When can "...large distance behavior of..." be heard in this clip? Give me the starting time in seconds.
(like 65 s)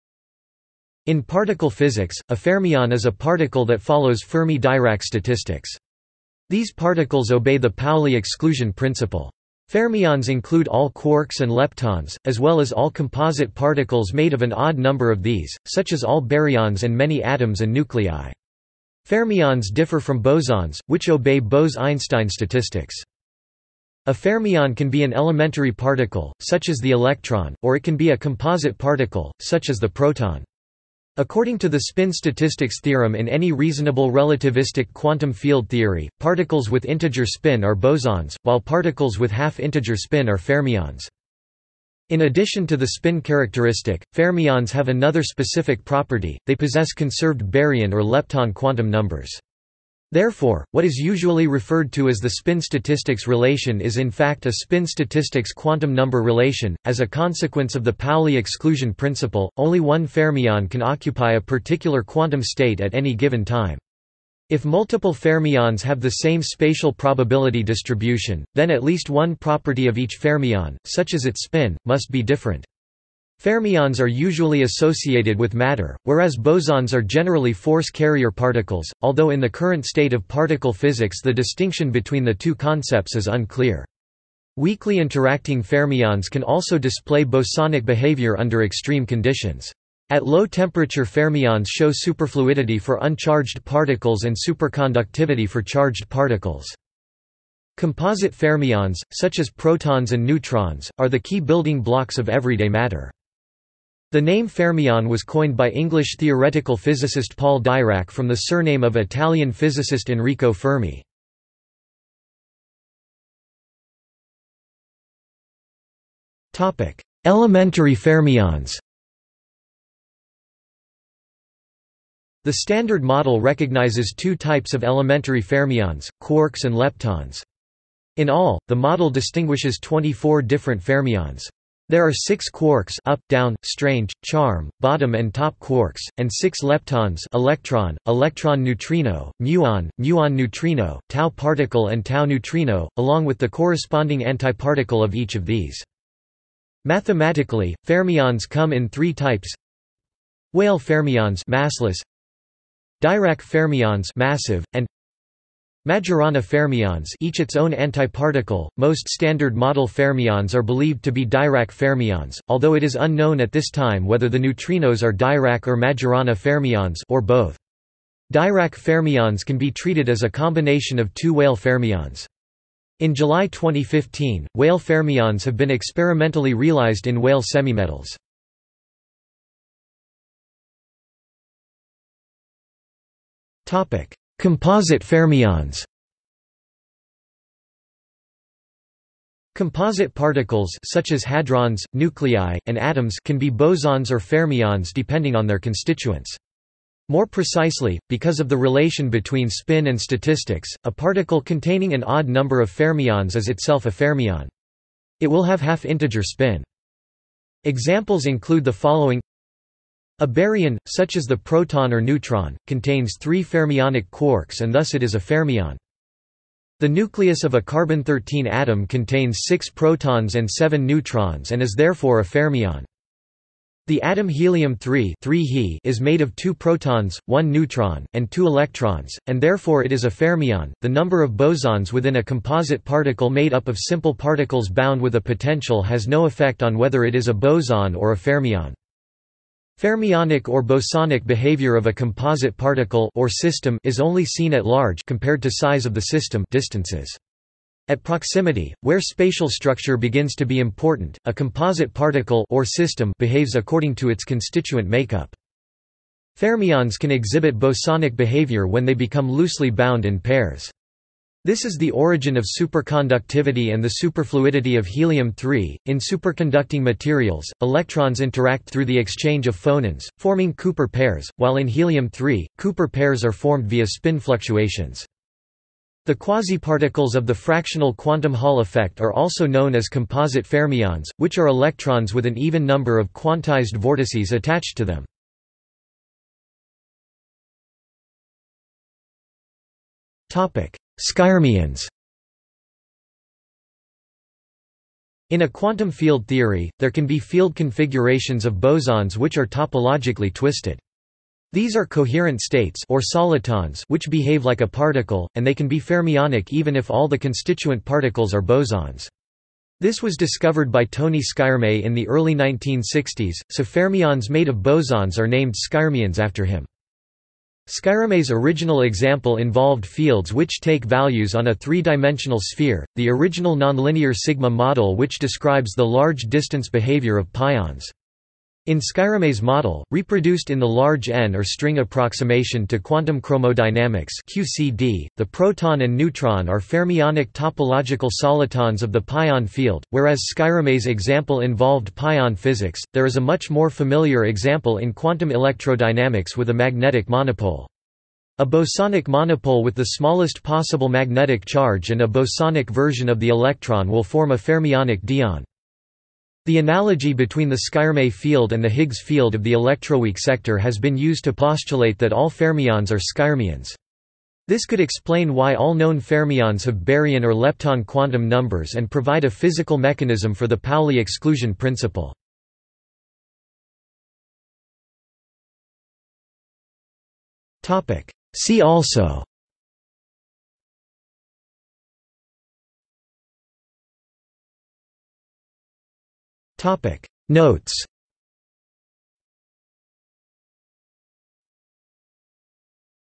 325 s.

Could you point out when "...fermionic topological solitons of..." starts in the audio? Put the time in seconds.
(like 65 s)
336 s.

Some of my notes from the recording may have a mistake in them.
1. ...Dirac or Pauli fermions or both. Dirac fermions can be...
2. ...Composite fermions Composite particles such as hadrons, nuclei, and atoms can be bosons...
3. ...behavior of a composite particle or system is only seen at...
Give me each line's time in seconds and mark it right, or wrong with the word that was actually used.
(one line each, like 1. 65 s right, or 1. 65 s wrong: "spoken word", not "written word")
1. 165 s wrong: "Majorana", not "Pauli"
2. 184 s right
3. 241 s right.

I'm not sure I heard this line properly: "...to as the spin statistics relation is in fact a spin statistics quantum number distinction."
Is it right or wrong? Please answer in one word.
wrong.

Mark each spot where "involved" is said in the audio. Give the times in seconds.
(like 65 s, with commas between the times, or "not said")
319 s, 341 s.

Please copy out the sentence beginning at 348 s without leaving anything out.
A bosonic monopole with the smallest possible magnetic charge and a bosonic version of the electron will form a fermionic dyon.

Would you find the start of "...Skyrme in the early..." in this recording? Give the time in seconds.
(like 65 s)
311 s.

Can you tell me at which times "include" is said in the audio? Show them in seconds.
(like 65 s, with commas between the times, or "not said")
10 s, 208 s.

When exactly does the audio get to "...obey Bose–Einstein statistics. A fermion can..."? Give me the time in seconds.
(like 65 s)
21 s.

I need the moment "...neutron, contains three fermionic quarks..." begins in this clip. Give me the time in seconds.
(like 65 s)
211 s.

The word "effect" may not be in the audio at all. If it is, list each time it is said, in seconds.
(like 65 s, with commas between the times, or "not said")
236 s, 278 s.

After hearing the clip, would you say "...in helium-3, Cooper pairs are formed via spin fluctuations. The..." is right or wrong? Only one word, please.
right.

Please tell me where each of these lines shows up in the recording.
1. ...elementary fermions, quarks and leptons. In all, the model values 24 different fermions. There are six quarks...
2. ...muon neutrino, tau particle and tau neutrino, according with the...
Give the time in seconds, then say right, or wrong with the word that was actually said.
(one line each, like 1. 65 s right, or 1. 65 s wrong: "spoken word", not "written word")
1. 124 s wrong: "distinguishes", not "values"
2. 139 s wrong: "along", not "according".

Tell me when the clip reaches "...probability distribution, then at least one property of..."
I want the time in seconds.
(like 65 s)
66 s.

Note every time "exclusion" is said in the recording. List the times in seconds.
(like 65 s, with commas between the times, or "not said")
8 s, 58 s, 370 s.